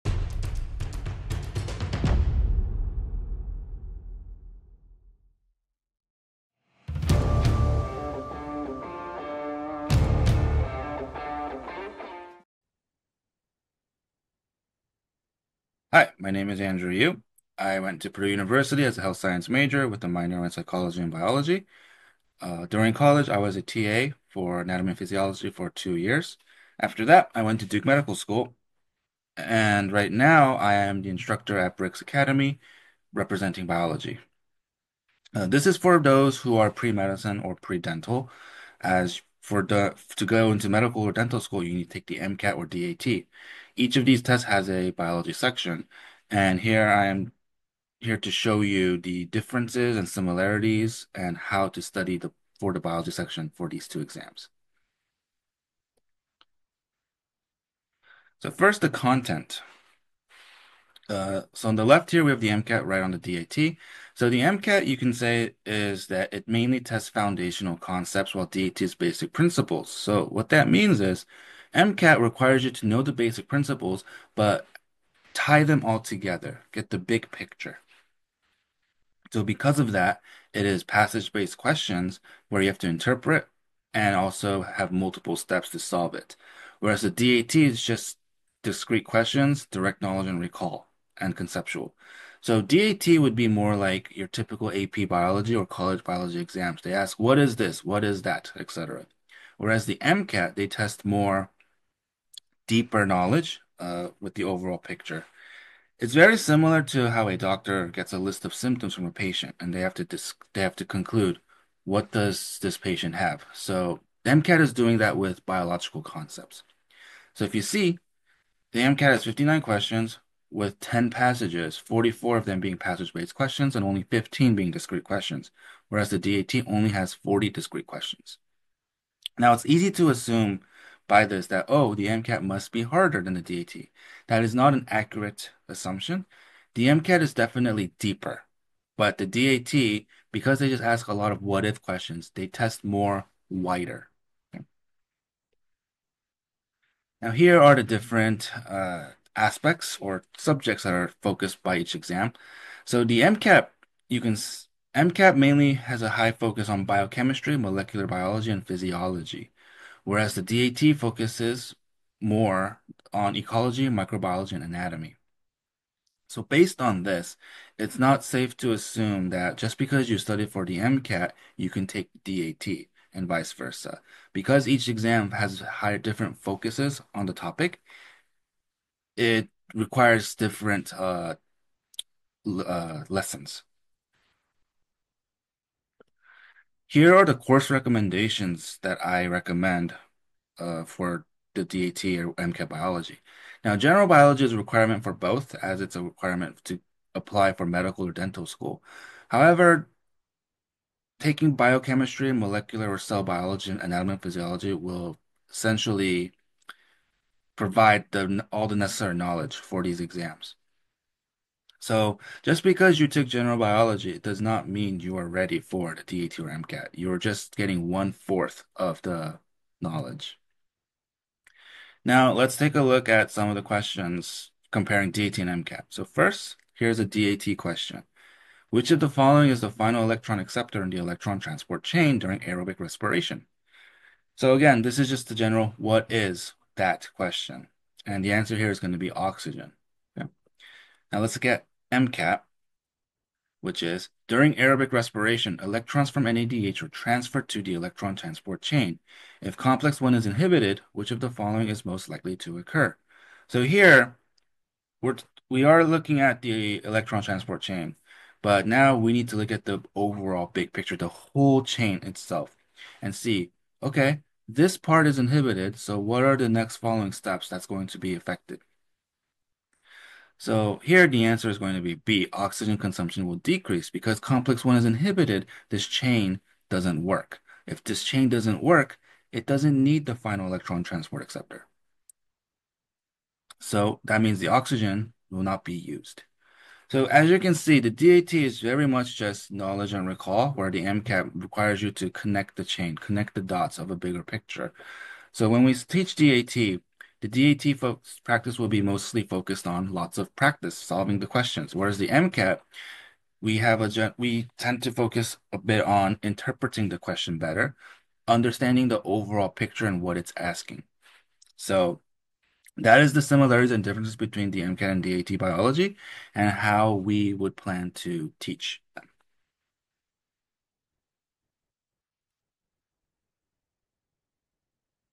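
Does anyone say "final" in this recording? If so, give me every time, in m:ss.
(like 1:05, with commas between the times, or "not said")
3:49, 4:40.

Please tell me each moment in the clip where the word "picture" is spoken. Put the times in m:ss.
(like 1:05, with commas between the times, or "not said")
1:17, 1:44, 4:20, 4:54, 5:09.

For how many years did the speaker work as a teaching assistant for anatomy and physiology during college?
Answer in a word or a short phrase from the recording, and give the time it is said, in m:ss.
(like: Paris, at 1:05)
2, at 0:25.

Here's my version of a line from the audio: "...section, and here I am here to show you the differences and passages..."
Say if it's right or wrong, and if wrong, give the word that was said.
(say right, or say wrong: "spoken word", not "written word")
wrong: "similarities", not "passages".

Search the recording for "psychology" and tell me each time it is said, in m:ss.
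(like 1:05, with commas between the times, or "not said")
0:20.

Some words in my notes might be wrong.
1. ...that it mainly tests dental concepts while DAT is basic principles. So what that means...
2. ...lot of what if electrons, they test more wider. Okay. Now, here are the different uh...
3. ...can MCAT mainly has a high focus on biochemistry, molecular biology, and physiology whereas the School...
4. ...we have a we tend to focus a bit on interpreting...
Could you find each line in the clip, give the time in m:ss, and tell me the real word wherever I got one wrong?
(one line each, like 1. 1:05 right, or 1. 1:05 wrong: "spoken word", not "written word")
1. 1:06 wrong: "foundational", not "dental"
2. 2:21 wrong: "questions", not "electrons"
3. 2:34 wrong: "DAT", not "School"
4. 5:03 right.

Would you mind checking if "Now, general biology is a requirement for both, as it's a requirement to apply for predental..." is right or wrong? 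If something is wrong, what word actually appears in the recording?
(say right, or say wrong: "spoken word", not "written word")
wrong: "medical", not "predental".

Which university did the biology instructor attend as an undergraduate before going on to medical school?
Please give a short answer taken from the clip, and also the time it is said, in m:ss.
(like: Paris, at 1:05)
Purdue University, at 0:18.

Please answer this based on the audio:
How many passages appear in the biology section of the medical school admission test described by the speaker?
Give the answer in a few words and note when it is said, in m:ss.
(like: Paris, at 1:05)
10, at 2:00.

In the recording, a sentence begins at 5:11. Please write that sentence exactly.
So that is the similarities and differences between the MCAT and DAT biology and how we would plan to teach them.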